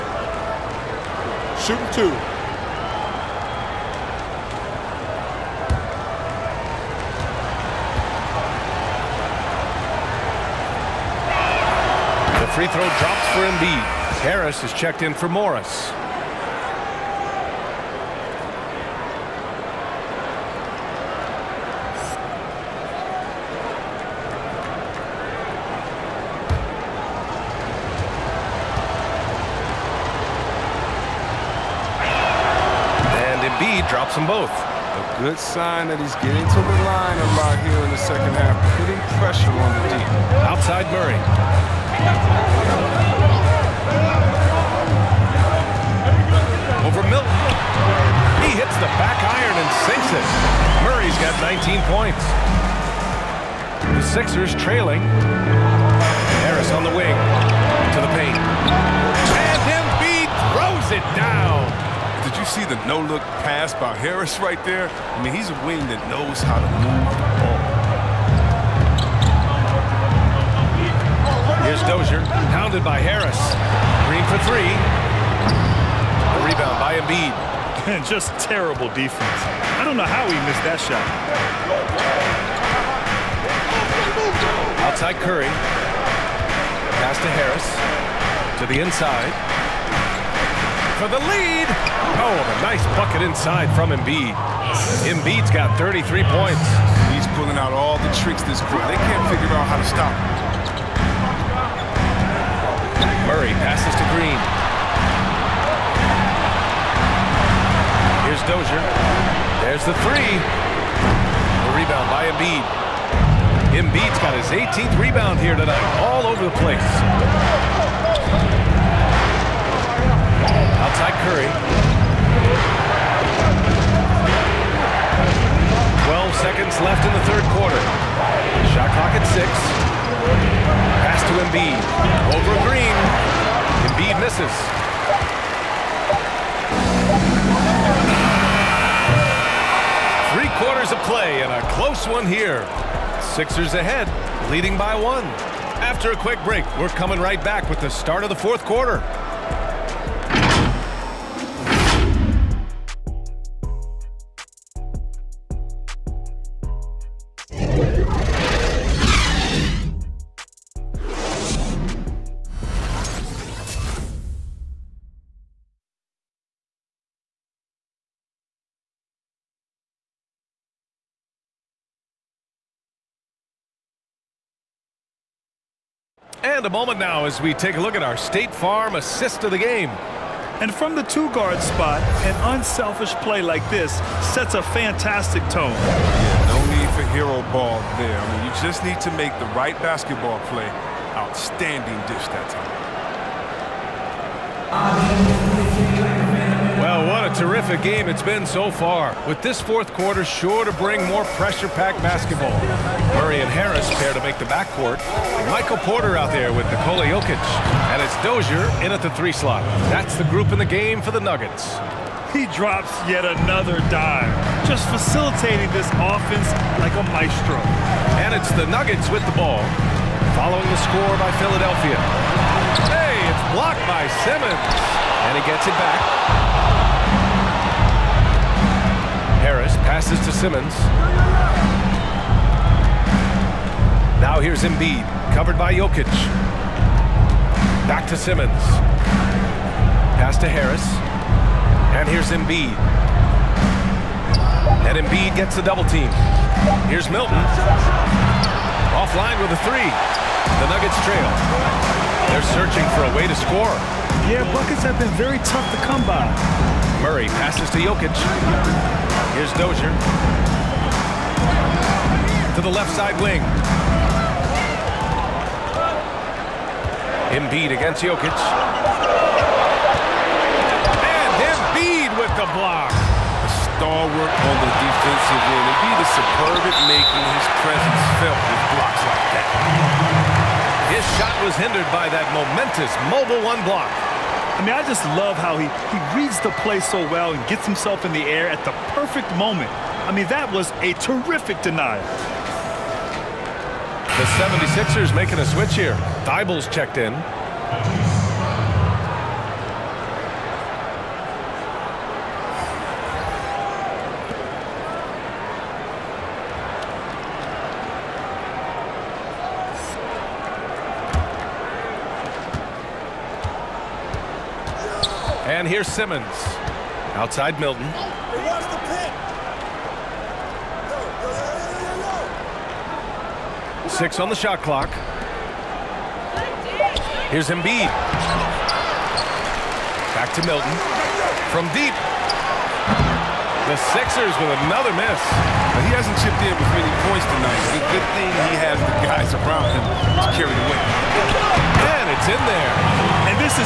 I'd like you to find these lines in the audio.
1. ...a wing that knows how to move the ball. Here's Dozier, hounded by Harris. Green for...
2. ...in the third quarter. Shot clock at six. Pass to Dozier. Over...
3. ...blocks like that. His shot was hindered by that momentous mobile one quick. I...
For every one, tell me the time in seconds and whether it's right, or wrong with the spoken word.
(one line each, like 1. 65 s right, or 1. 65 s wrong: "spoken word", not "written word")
1. 65 s right
2. 127 s wrong: "Embiid", not "Dozier"
3. 278 s wrong: "block", not "quick".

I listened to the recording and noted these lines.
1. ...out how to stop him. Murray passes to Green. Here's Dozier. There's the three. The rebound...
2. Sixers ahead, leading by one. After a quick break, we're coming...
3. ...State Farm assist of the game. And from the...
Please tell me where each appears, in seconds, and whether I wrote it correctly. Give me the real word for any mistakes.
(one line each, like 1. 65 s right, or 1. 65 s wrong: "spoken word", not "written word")
1. 99 s right
2. 143 s right
3. 178 s right.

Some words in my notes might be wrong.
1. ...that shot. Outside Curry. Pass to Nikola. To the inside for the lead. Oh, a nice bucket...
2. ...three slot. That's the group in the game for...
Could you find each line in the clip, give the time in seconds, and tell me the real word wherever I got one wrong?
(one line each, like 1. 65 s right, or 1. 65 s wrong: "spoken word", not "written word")
1. 80 s wrong: "Harris", not "Nikola"
2. 209 s right.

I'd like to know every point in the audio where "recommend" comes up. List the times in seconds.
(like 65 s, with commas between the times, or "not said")
not said.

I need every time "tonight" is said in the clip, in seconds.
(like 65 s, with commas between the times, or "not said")
115 s, 337 s.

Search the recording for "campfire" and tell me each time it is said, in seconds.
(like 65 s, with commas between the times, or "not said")
not said.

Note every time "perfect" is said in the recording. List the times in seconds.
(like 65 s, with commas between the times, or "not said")
288 s.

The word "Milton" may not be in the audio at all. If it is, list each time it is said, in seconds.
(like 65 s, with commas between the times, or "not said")
47 s, 247 s, 317 s, 330 s.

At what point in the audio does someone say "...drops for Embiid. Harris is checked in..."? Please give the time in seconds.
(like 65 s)
12 s.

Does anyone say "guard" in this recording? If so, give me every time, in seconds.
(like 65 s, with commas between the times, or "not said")
181 s.